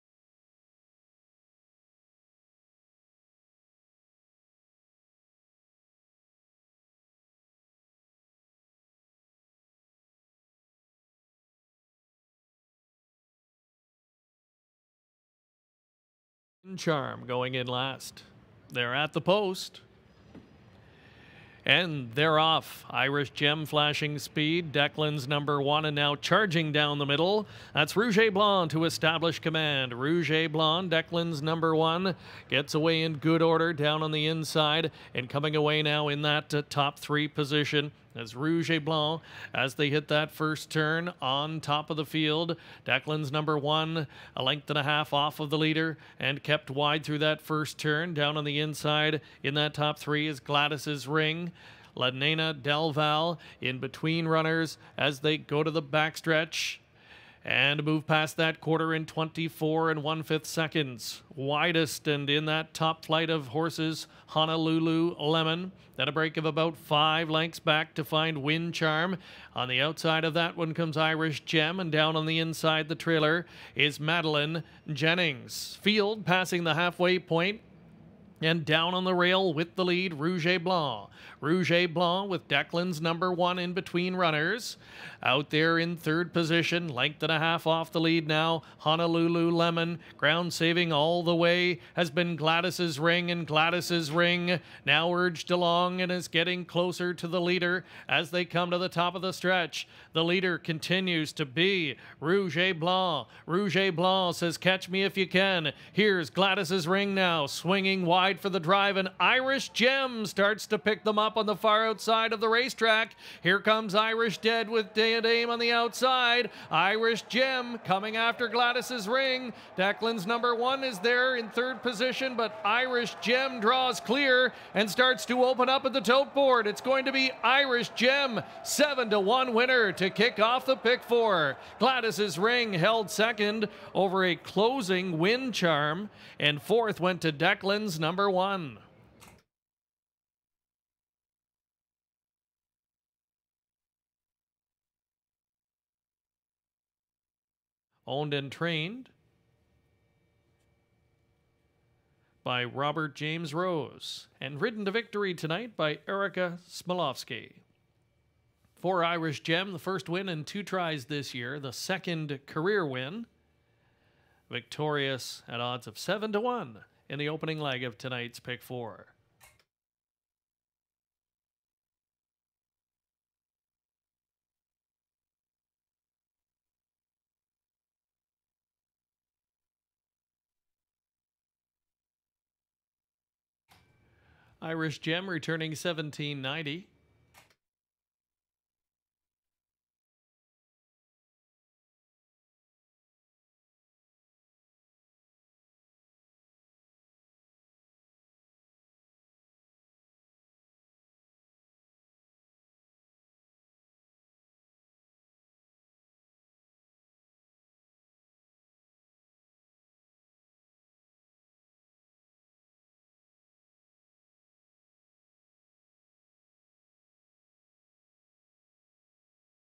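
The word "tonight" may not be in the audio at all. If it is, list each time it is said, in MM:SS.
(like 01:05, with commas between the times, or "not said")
02:35, 02:47.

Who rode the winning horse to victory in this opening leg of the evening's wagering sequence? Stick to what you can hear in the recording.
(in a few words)
Erica Smolovsky.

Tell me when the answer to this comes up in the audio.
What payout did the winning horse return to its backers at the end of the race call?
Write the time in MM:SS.
03:05.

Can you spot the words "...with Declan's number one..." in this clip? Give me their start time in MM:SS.
01:22.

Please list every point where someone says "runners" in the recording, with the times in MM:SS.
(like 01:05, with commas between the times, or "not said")
00:54, 01:24.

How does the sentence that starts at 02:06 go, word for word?
It's going to be Irish Gem, seven to one winner to kick off the pick four.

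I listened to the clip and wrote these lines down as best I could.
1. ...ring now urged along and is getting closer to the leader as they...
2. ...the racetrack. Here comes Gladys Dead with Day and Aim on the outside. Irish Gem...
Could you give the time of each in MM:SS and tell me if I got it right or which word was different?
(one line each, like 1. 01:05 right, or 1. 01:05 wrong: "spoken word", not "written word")
1. 01:34 right
2. 01:52 wrong: "Irish", not "Gladys".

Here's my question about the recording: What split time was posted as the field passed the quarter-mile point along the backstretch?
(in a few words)
24 and 1/5 seconds.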